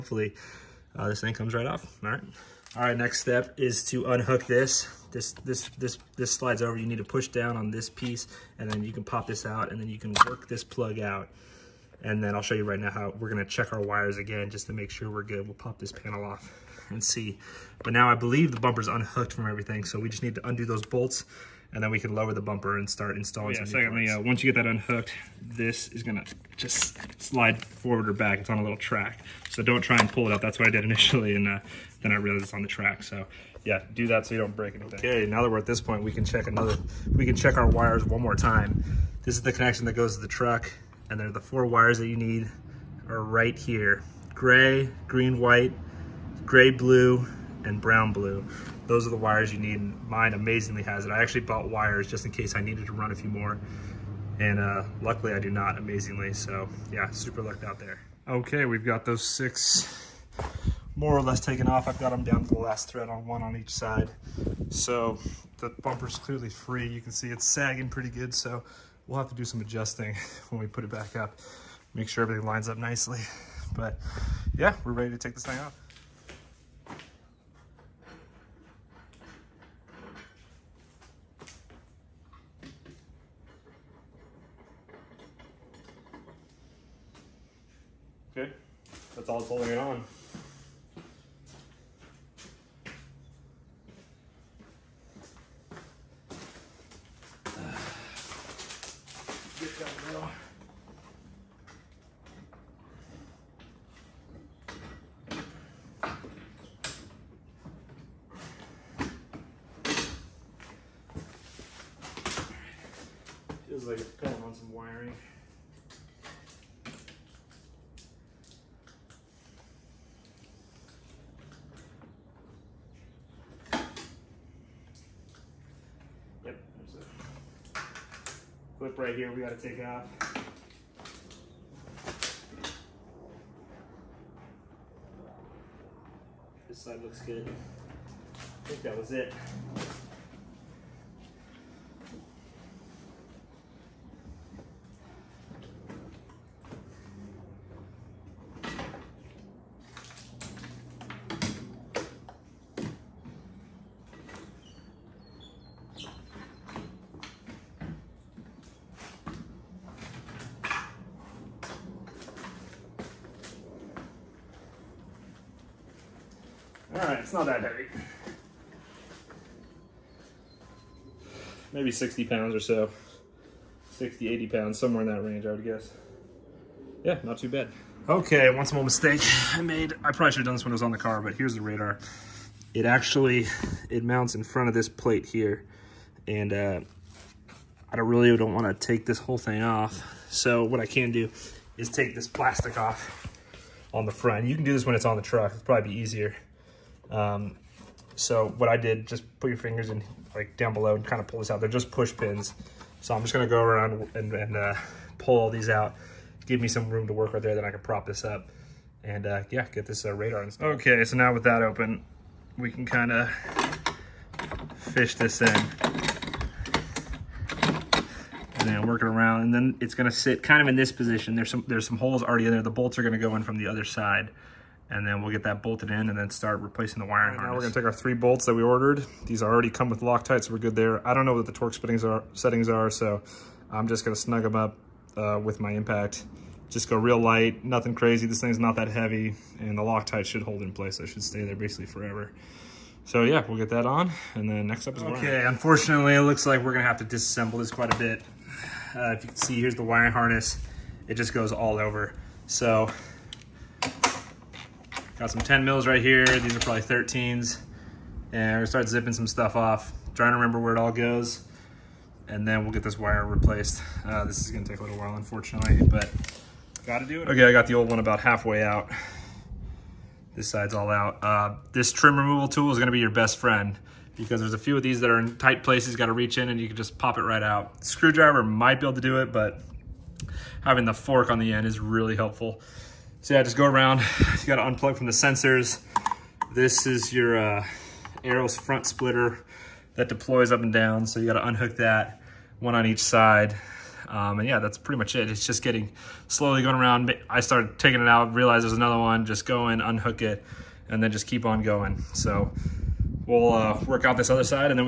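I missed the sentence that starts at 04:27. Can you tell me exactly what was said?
Okay, I got the old one about halfway out.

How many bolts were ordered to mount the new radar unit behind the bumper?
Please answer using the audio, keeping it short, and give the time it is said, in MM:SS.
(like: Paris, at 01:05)
3, at 03:47.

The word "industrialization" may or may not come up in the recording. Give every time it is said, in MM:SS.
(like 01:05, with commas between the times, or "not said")
not said.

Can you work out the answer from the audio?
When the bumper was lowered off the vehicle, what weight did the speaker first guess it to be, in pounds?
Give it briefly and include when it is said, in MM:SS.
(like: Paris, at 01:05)
60, at 02:51.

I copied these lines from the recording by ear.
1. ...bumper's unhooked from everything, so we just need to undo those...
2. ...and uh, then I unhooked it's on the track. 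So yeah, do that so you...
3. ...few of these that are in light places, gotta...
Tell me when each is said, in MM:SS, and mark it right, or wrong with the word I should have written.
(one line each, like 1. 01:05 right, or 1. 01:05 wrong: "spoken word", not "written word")
1. 00:18 right
2. 00:31 wrong: "realized", not "unhooked"
3. 04:34 wrong: "tight", not "light".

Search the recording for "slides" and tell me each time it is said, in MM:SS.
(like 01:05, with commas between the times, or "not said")
00:06, 00:27.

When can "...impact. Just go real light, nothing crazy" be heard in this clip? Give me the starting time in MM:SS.
03:55.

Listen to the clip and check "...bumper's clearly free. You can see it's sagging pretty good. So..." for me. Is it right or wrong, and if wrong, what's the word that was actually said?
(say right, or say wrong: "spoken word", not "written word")
right.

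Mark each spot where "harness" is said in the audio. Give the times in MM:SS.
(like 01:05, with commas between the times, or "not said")
03:47, 04:10.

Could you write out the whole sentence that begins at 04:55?
It's just getting slowly going around.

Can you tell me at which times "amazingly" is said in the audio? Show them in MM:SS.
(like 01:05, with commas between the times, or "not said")
00:50, 00:55.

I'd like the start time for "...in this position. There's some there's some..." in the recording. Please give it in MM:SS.
03:40.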